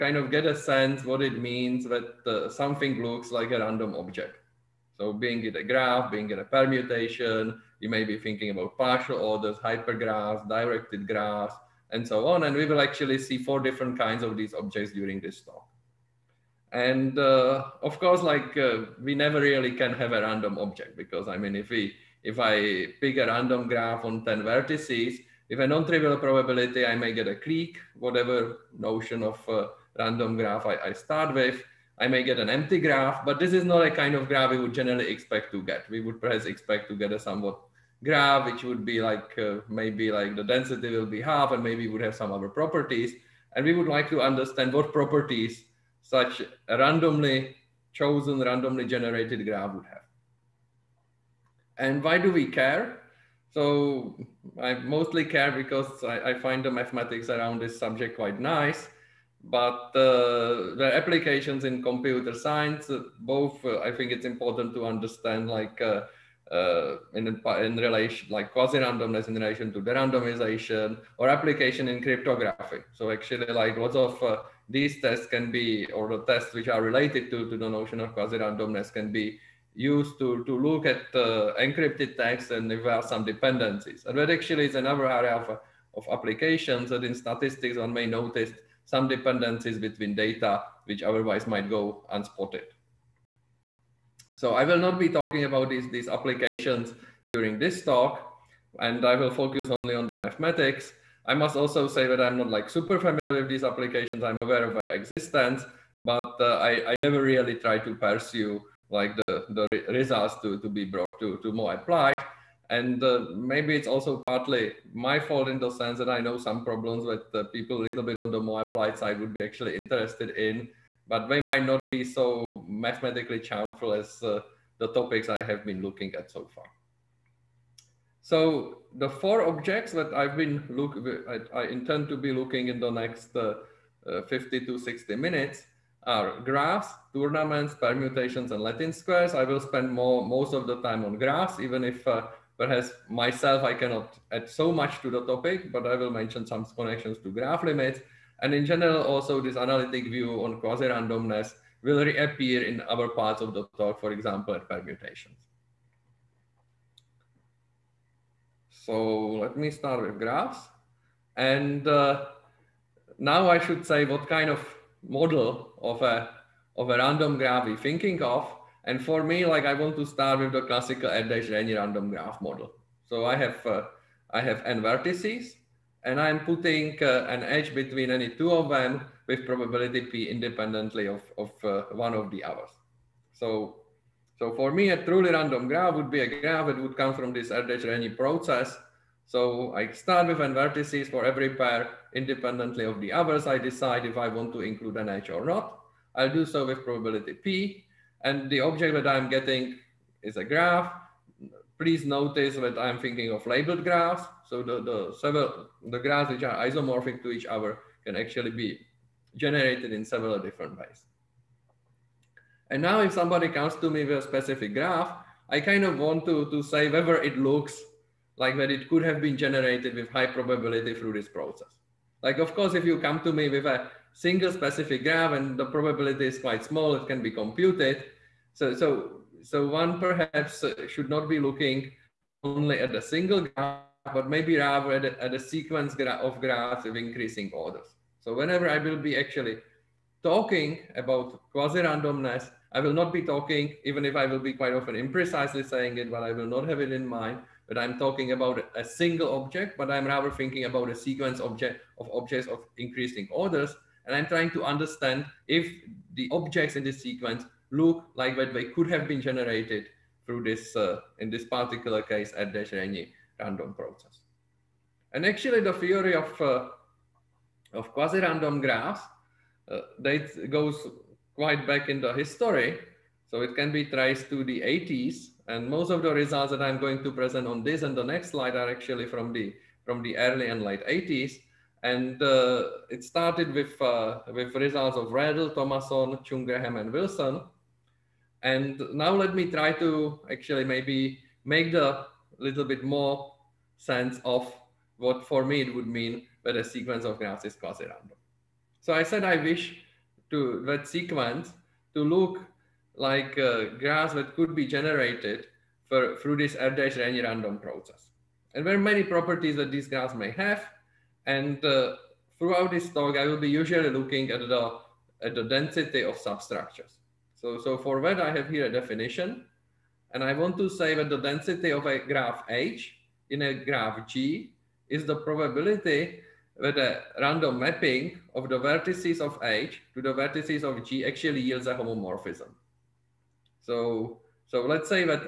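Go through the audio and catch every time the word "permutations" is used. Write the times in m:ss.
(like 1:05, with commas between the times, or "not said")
0:06, 2:17, 2:34.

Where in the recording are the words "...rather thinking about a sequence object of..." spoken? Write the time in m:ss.
4:10.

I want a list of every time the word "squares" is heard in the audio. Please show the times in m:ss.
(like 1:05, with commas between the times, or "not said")
2:18.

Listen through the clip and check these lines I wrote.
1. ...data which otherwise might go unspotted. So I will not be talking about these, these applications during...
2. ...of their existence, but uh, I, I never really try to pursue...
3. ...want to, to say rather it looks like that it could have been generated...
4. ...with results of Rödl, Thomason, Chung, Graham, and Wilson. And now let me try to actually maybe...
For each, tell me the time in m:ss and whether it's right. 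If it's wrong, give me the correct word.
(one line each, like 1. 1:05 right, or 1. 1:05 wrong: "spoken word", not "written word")
1. 1:30 right
2. 1:44 right
3. 3:35 wrong: "whether", not "rather"
4. 4:44 right.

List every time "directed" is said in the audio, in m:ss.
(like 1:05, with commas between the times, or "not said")
0:10.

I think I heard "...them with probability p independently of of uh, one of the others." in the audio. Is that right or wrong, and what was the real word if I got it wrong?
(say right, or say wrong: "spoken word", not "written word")
right.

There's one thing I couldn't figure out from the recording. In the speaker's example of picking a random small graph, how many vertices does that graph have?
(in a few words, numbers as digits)
10.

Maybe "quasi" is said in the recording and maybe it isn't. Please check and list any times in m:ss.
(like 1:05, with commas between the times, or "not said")
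1:08, 1:18, 2:30, 4:01, 4:27, 4:57.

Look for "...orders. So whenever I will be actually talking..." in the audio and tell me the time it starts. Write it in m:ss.
3:57.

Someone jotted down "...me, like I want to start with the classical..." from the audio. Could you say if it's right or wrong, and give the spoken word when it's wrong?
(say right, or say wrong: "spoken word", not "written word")
right.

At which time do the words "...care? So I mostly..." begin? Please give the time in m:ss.
0:52.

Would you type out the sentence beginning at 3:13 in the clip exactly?
I decide if I want to include an edge or not.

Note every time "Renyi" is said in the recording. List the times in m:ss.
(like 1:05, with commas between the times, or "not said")
2:51, 3:07, 4:22, 5:06.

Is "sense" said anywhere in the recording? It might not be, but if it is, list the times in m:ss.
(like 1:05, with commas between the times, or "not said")
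0:00, 1:55, 4:53.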